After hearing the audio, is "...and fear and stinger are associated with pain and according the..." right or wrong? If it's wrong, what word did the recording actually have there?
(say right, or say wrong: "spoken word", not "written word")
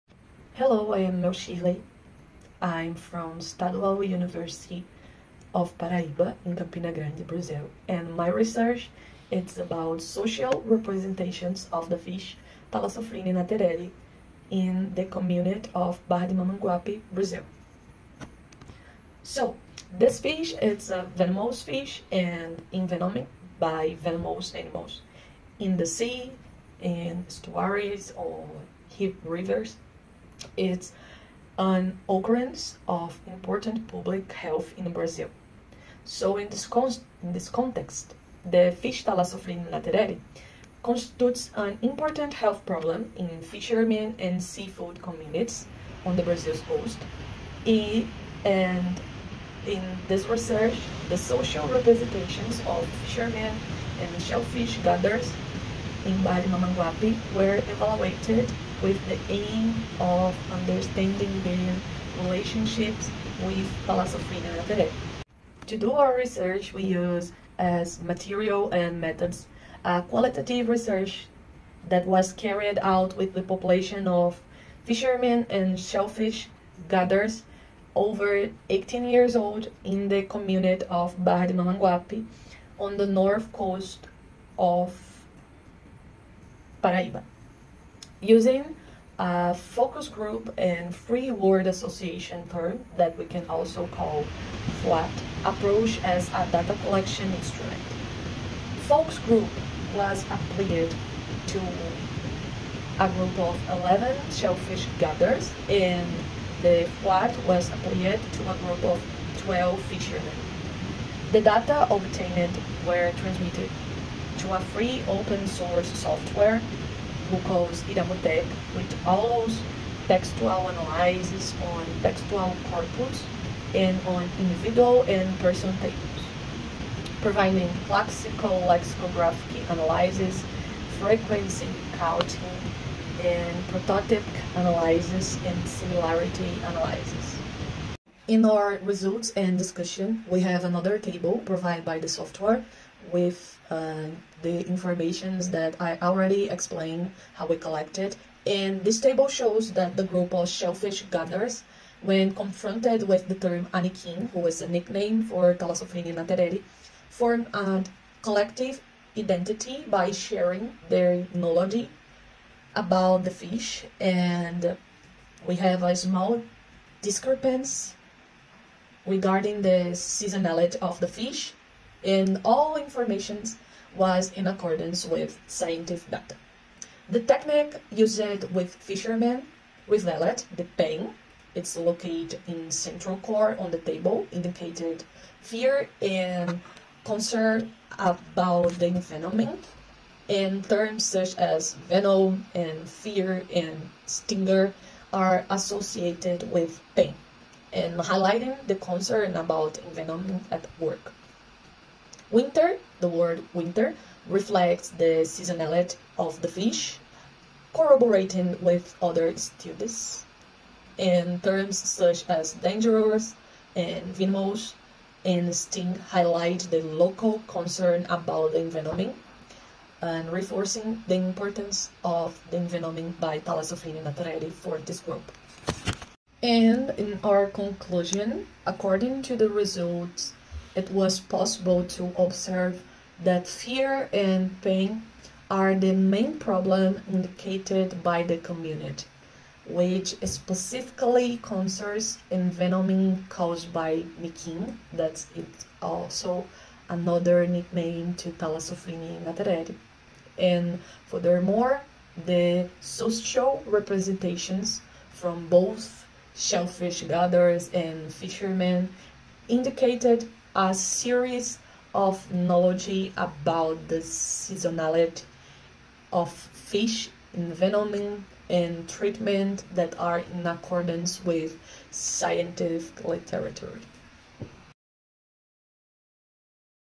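wrong: "highlighting", not "according".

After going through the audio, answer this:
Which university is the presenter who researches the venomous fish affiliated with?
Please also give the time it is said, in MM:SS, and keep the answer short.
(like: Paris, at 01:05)
Estadual University of Paraíba, at 00:03.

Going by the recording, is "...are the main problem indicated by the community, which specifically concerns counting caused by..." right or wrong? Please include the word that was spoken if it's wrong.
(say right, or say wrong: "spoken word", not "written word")
wrong: "envenoming", not "counting".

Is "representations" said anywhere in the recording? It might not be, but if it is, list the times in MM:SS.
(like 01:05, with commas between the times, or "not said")
00:10, 00:51, 04:13.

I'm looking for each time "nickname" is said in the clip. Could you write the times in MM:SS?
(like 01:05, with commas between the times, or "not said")
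02:34, 04:07.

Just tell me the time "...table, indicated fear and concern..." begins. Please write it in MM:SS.
03:03.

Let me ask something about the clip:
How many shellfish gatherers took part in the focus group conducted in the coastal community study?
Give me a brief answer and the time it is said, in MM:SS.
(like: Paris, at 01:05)
11, at 01:43.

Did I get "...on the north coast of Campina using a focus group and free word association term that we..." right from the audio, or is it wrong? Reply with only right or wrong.
wrong.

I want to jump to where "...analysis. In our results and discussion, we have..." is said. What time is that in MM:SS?
02:16.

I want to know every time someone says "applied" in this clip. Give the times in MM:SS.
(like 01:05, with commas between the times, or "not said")
01:40, 01:47.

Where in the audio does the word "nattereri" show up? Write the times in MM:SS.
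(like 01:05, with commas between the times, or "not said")
00:13, 00:39, 01:04, 02:36, 03:44.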